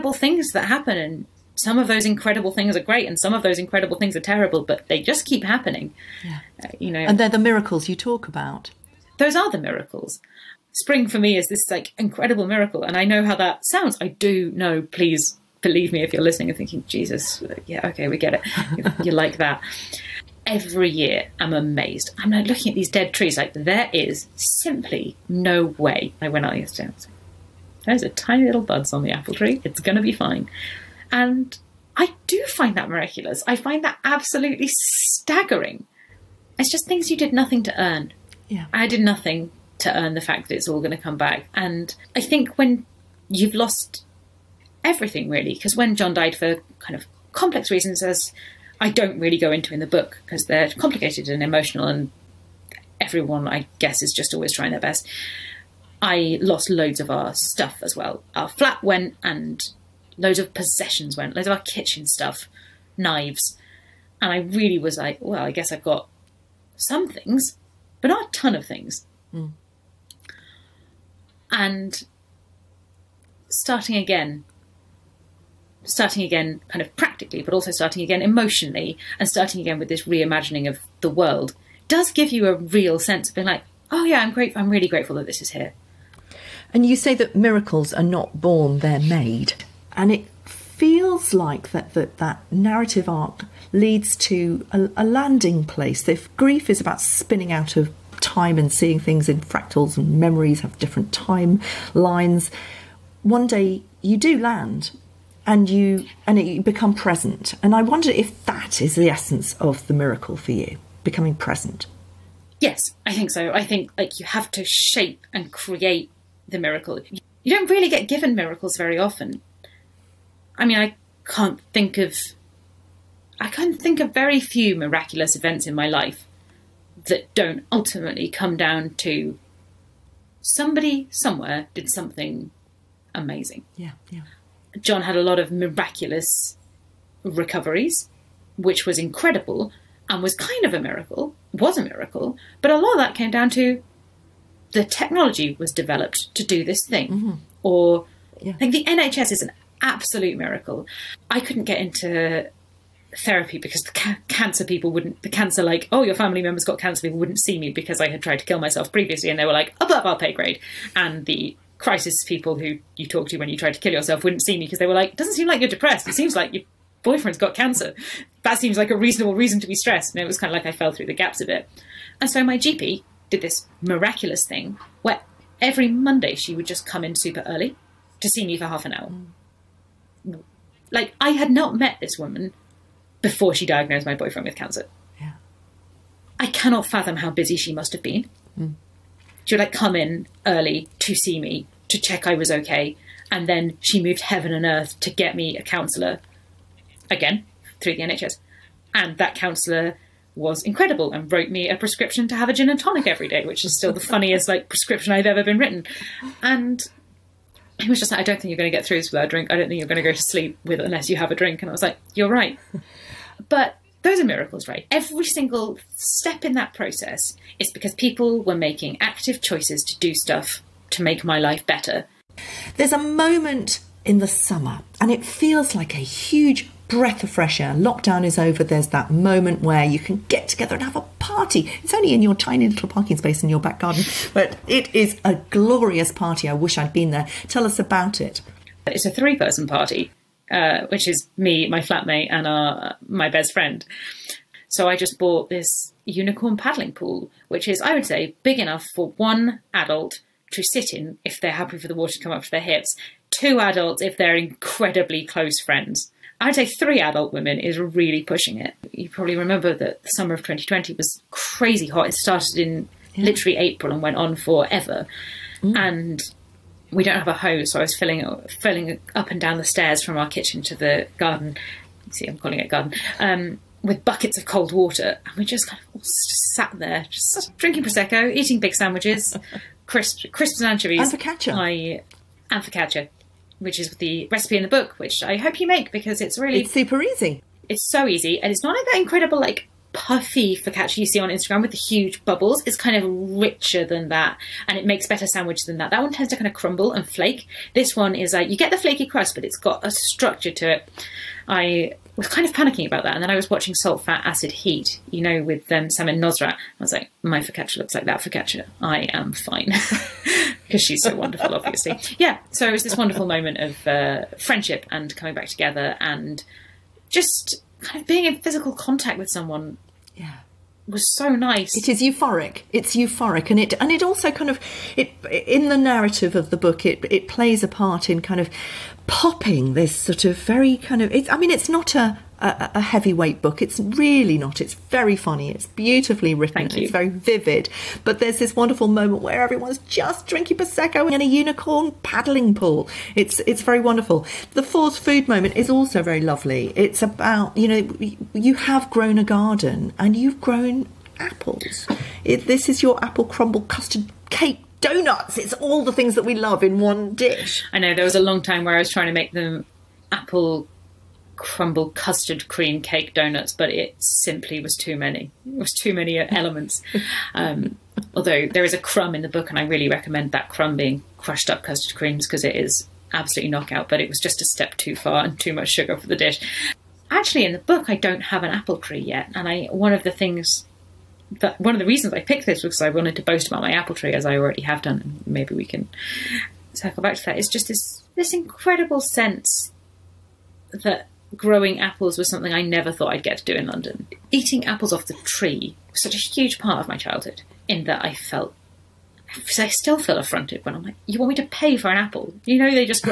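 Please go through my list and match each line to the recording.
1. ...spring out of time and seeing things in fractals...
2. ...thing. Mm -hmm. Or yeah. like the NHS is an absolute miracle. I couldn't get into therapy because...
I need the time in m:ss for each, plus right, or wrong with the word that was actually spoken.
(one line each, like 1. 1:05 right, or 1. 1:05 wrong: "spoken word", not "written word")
1. 1:36 wrong: "spinning", not "spring"
2. 2:26 right.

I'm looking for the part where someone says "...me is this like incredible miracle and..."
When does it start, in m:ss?
0:11.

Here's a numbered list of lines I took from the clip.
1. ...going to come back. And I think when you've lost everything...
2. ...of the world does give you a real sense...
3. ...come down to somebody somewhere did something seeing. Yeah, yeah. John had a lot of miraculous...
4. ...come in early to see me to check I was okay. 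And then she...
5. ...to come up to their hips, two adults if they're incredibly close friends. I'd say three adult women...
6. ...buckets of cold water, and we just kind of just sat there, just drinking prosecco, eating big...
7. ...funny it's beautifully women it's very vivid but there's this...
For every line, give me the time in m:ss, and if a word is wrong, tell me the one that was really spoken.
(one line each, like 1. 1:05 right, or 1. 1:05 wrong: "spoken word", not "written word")
1. 0:40 right
2. 1:20 right
3. 2:08 wrong: "amazing", not "seeing"
4. 3:09 right
5. 4:12 right
6. 4:34 right
7. 5:35 wrong: "written", not "women".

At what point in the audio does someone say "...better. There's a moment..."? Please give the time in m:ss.
3:41.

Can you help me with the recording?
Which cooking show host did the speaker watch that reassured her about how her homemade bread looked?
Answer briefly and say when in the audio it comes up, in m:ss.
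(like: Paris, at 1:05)
Samin Nosrat, at 5:05.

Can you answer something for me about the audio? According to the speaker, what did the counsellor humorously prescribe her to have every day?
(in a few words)
a gin and tonic.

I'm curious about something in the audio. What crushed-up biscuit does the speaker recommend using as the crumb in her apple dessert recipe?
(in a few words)
custard creams.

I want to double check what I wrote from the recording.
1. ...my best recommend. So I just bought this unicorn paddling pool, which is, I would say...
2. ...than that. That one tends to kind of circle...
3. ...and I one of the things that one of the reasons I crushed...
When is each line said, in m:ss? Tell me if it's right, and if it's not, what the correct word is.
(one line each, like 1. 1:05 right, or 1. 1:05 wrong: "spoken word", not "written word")
1. 4:03 wrong: "friend", not "recommend"
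2. 4:55 wrong: "crumble", not "circle"
3. 6:19 wrong: "picked", not "crushed".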